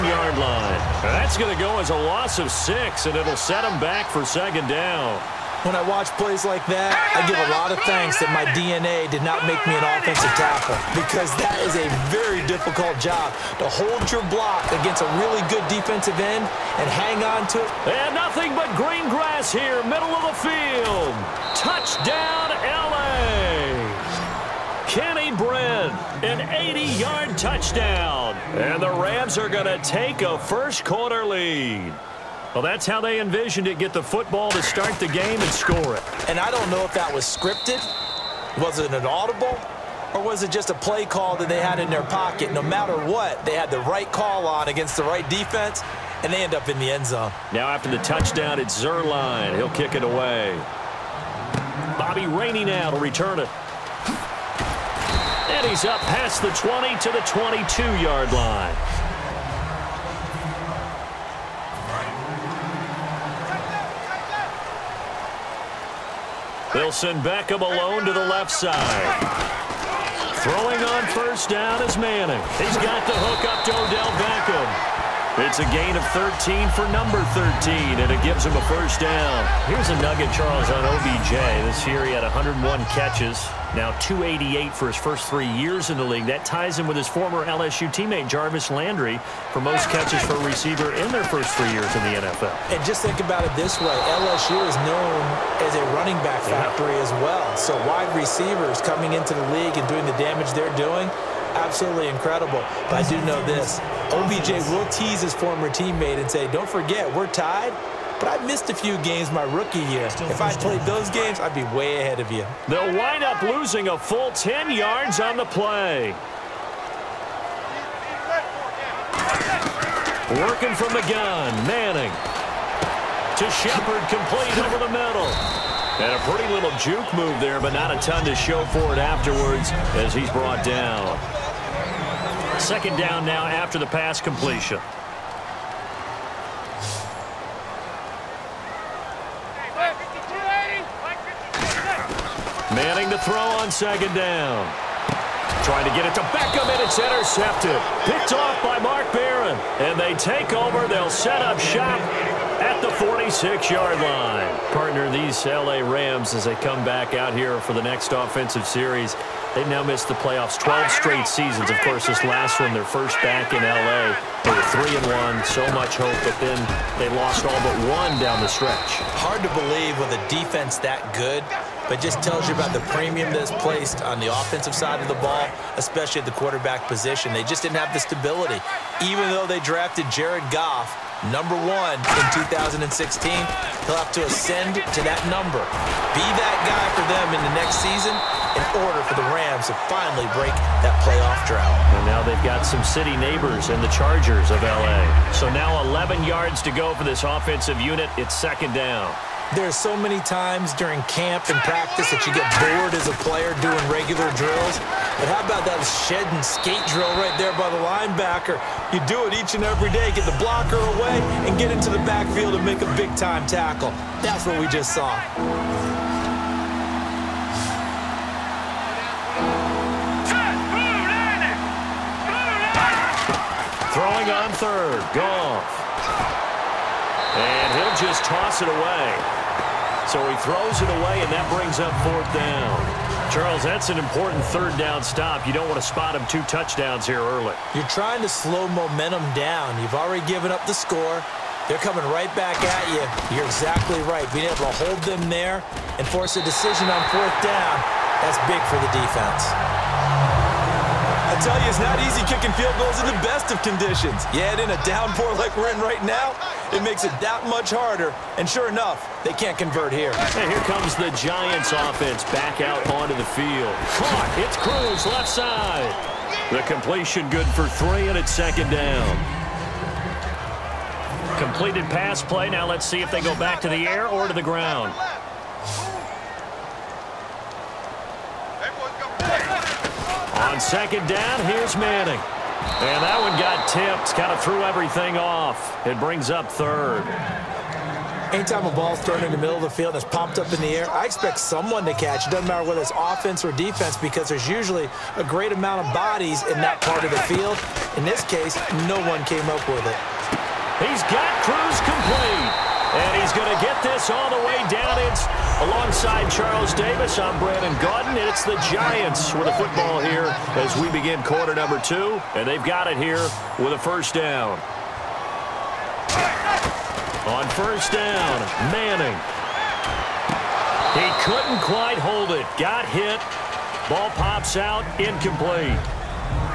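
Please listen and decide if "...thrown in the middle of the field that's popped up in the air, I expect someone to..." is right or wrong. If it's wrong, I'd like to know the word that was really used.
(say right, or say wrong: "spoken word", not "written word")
right.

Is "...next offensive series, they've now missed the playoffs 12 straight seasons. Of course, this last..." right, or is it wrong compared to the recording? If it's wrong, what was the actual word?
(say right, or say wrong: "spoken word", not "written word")
right.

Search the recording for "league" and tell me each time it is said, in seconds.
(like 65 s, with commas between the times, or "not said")
86 s, 99 s.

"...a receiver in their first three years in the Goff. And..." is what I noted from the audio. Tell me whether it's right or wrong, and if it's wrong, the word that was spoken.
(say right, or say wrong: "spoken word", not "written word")
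wrong: "NFL", not "Goff".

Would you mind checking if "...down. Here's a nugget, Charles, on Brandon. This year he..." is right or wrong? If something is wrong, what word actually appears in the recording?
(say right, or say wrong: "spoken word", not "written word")
wrong: "OBJ", not "Brandon".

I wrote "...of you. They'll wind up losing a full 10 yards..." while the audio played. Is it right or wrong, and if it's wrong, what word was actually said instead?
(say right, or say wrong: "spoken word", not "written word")
right.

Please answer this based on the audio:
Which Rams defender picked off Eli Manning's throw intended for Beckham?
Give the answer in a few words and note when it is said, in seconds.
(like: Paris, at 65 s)
Mark Barron, at 148 s.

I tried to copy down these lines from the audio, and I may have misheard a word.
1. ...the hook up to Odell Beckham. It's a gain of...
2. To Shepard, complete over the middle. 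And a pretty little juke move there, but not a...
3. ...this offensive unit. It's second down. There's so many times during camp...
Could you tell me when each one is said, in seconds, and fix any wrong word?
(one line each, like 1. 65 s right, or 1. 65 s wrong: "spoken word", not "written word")
1. 73 s right
2. 123 s right
3. 197 s right.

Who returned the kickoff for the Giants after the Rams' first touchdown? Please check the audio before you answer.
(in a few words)
Bobby Rainey.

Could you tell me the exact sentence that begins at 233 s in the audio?
Charles, that's an important third down stop.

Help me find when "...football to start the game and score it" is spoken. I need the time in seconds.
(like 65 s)
34 s.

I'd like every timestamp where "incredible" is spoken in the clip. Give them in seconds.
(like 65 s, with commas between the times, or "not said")
102 s.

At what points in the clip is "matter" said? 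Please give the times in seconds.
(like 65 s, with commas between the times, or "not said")
42 s, 292 s.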